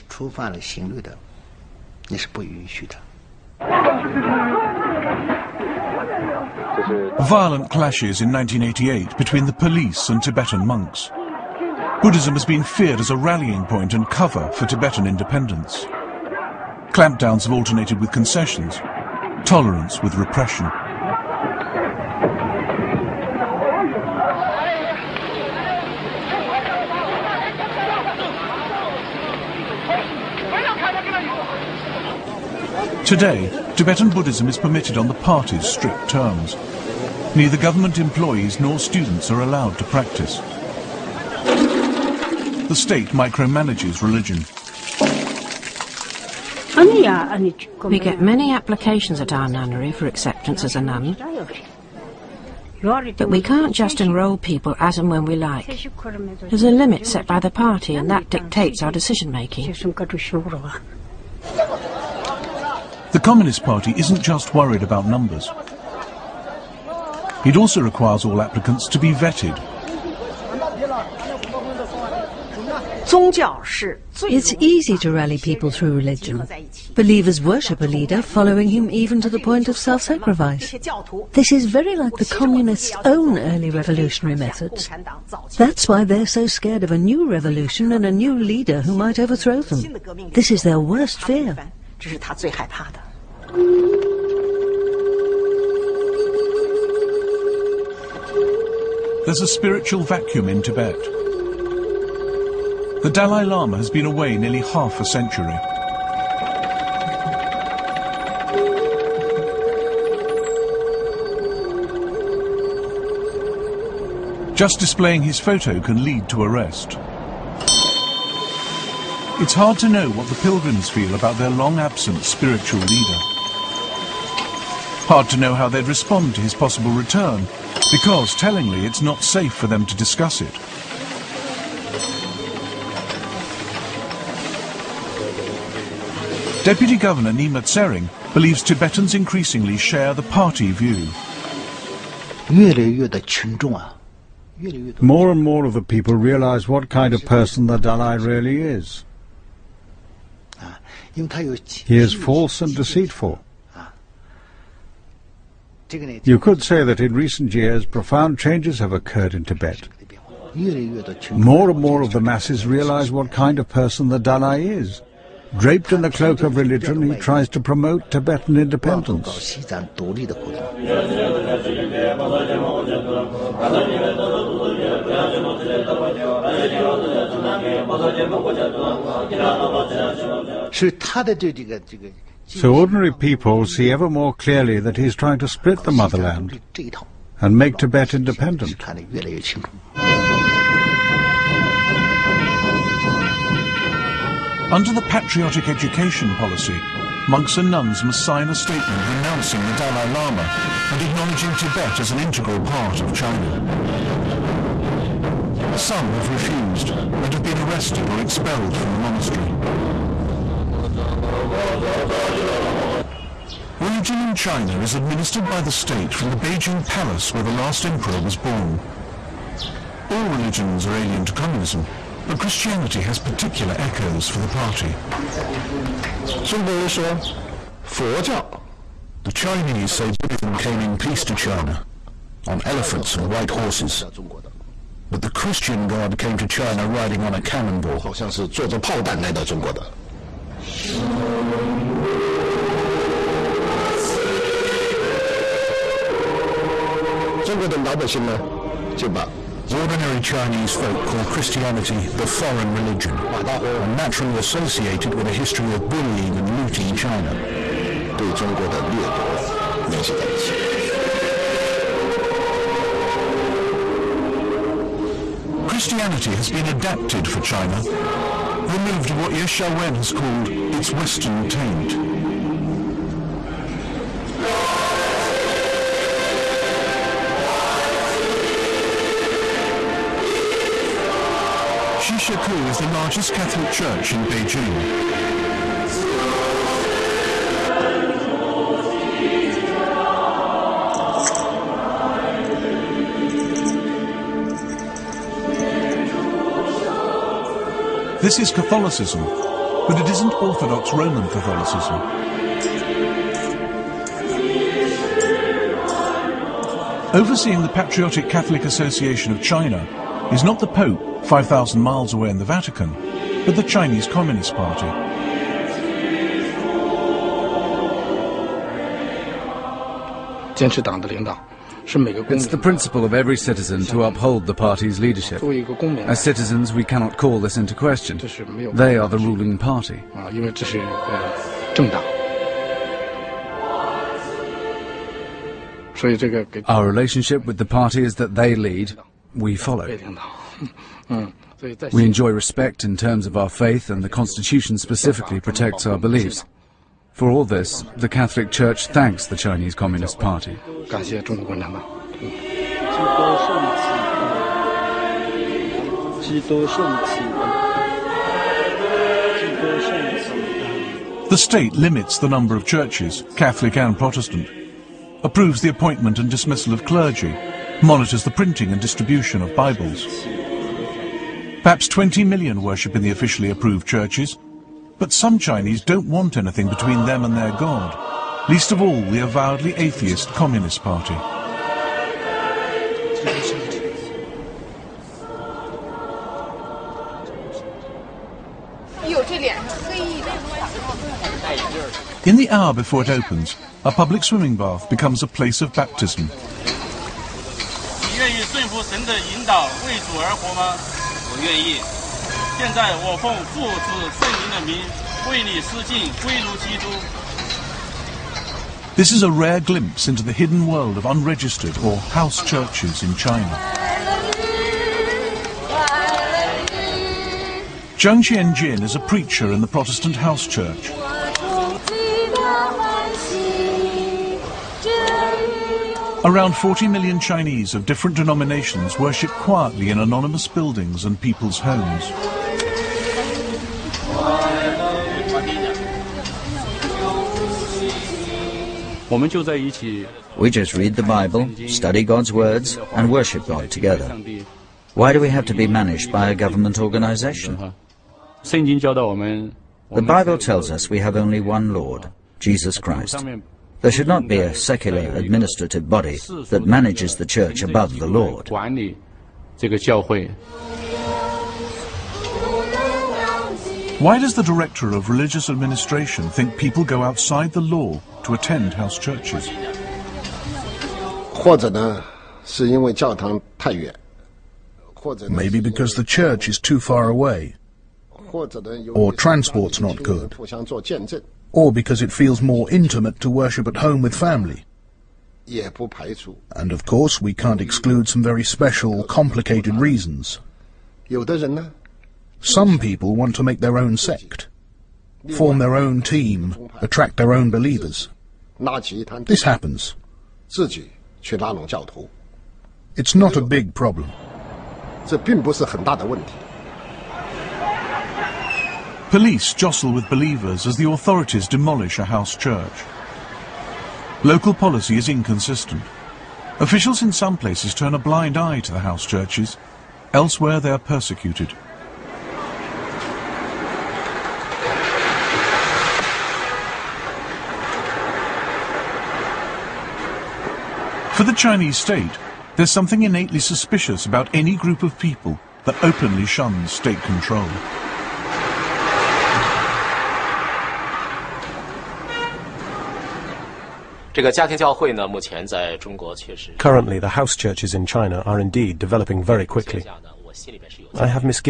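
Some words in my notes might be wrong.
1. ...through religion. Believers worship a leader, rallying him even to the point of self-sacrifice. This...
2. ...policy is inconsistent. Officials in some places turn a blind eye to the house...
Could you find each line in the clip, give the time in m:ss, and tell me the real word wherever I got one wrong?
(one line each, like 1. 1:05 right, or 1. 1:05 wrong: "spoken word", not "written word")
1. 1:15 wrong: "following", not "rallying"
2. 8:34 right.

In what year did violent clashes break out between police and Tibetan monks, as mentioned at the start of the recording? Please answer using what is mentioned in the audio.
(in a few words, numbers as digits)
1988.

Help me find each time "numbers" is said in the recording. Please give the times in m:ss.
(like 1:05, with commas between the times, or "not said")
1:05, 6:02.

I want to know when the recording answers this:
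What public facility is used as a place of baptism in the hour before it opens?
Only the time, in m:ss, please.
6:34.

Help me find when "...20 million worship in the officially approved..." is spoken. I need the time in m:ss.
6:11.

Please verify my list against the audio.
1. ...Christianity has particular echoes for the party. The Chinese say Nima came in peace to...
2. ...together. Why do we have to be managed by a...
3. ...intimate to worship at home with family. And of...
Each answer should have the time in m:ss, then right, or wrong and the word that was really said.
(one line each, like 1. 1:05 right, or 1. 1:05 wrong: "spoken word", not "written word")
1. 3:42 wrong: "Buddhism", not "Nima"
2. 7:23 right
3. 8:02 right.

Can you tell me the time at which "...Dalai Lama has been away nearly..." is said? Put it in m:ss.
1:43.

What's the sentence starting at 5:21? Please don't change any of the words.
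It's the principle of every citizen to uphold the party's leadership.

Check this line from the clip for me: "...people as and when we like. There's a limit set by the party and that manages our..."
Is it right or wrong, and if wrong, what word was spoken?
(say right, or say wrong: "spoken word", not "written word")
wrong: "dictates", not "manages".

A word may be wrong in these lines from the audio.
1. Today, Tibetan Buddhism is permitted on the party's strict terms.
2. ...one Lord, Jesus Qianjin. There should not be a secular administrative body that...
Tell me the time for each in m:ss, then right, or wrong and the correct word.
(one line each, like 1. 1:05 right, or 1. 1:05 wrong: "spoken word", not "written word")
1. 0:33 right
2. 7:31 wrong: "Christ", not "Qianjin".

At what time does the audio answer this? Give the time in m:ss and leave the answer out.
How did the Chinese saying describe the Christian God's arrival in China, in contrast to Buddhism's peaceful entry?
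3:56.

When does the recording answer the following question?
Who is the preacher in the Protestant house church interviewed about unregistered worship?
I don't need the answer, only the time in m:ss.
6:57.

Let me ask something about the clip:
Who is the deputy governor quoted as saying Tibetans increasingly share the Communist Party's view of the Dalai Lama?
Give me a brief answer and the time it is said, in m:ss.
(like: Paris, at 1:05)
Nima Tsering, at 2:17.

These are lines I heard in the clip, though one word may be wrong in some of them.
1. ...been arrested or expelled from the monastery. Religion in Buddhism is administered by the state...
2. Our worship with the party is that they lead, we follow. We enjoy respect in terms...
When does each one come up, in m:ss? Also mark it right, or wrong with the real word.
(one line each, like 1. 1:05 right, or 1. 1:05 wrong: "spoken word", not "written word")
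1. 3:27 wrong: "China", not "Buddhism"
2. 5:36 wrong: "relationship", not "worship".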